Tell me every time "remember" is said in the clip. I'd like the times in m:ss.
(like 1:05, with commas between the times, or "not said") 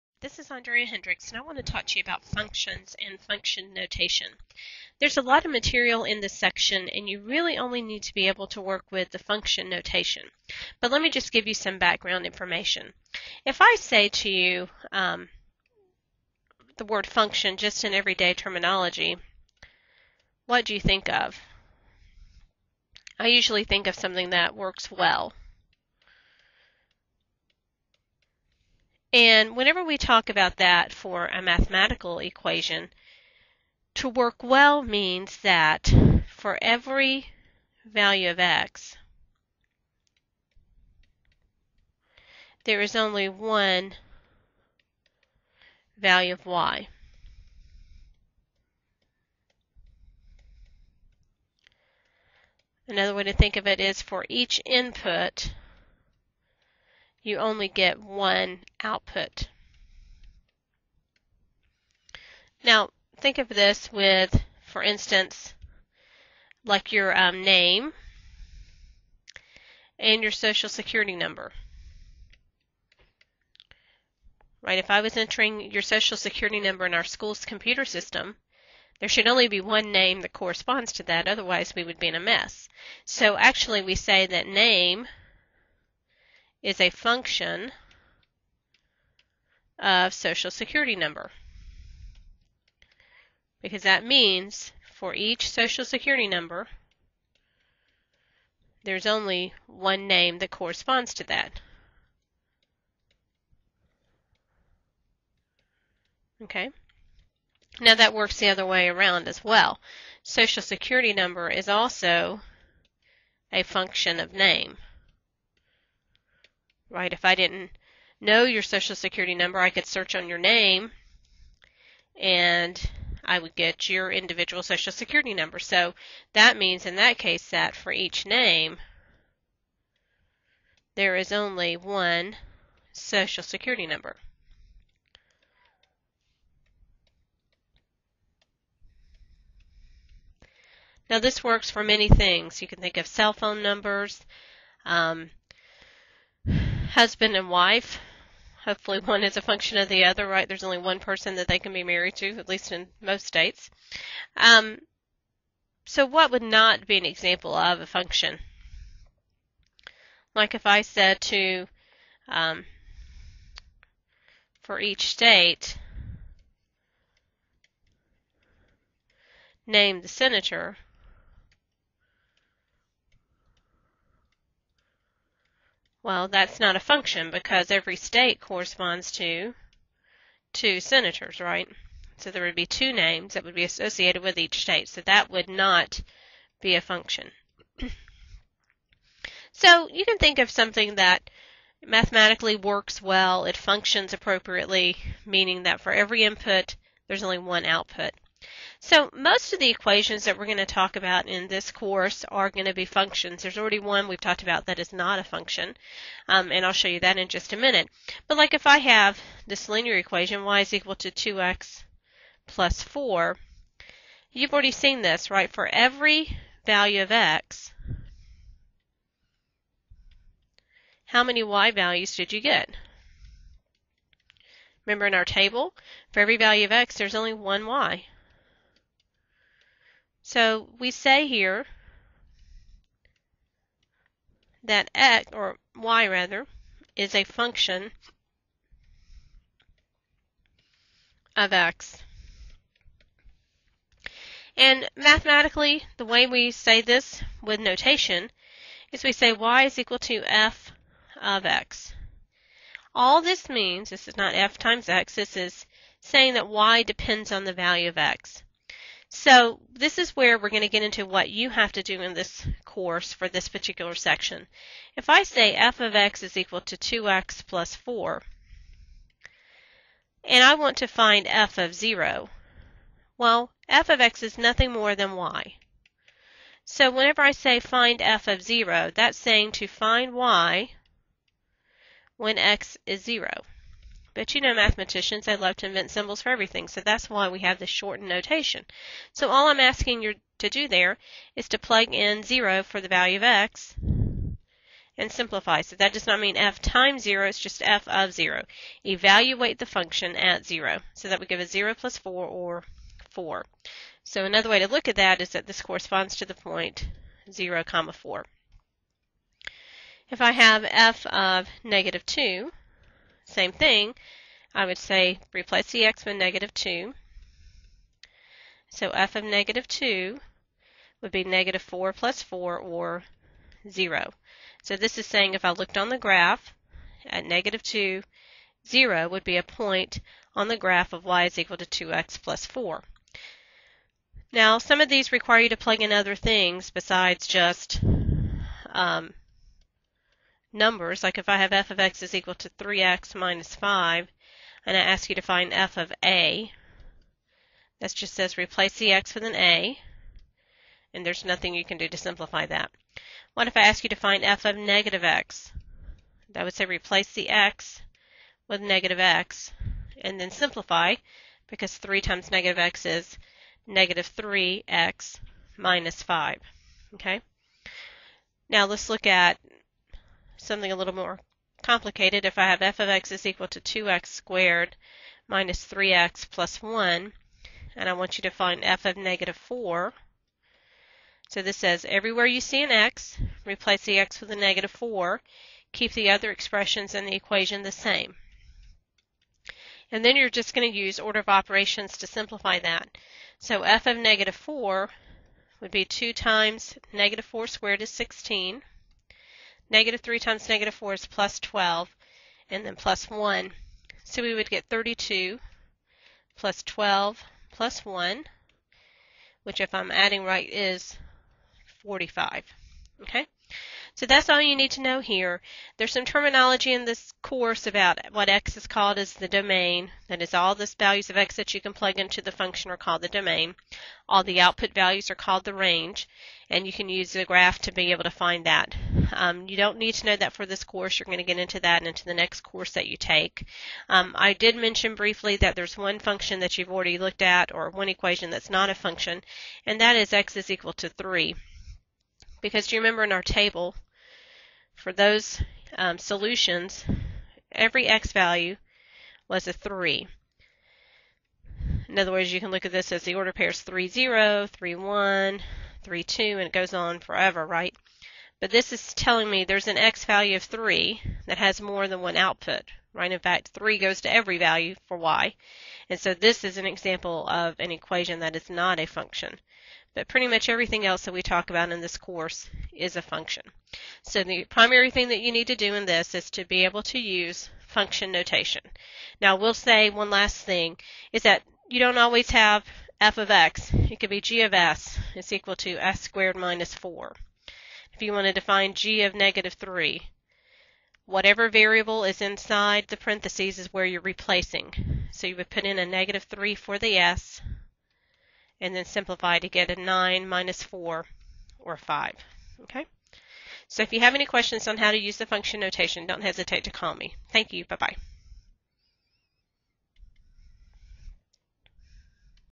3:44, 7:22.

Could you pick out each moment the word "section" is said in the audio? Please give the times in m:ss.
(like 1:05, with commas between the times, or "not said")
0:06, 4:23.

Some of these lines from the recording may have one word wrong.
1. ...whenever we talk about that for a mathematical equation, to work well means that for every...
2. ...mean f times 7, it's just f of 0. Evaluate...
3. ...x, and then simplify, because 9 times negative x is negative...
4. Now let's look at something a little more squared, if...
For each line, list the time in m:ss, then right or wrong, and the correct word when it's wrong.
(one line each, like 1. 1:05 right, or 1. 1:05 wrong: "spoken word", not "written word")
1. 0:29 right
2. 4:56 wrong: "0", not "7"
3. 5:58 wrong: "3", not "9"
4. 6:08 wrong: "complicated", not "squared".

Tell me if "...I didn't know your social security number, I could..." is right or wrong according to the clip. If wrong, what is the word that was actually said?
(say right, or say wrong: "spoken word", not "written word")
right.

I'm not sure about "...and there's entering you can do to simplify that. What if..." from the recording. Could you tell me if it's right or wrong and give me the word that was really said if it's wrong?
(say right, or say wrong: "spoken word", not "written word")
wrong: "nothing", not "entering".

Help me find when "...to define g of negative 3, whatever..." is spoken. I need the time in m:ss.
8:08.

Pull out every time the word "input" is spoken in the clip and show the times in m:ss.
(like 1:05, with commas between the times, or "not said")
0:54, 3:16.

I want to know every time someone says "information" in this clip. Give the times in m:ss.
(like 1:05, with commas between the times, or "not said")
0:12.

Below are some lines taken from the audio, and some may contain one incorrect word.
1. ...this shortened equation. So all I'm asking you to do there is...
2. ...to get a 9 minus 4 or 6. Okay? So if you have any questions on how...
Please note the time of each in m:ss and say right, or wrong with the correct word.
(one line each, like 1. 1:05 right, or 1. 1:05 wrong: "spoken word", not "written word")
1. 4:47 wrong: "notation", not "equation"
2. 8:19 wrong: "5", not "6".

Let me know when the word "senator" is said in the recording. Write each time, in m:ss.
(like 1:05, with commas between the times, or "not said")
2:50, 3:00.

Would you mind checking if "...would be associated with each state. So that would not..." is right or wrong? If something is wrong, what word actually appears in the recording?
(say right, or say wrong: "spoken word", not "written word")
right.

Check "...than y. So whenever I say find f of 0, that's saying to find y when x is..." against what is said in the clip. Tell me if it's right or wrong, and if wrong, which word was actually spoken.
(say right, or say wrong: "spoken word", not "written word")
right.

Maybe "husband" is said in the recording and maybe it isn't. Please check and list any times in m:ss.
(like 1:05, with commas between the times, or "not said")
2:26.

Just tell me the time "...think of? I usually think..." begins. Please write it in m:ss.
0:20.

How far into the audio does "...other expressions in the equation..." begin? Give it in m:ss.
6:26.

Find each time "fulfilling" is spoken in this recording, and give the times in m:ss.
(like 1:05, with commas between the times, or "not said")
not said.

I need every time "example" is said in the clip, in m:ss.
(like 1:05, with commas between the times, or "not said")
2:37, 7:46.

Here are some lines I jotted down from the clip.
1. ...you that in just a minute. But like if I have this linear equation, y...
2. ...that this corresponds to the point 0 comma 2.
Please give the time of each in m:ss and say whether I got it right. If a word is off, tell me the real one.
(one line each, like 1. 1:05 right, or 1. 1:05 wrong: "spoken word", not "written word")
1. 3:26 right
2. 5:05 wrong: "4", not "2".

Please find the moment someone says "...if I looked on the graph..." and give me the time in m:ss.
5:25.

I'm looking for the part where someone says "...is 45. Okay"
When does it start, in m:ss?
6:50.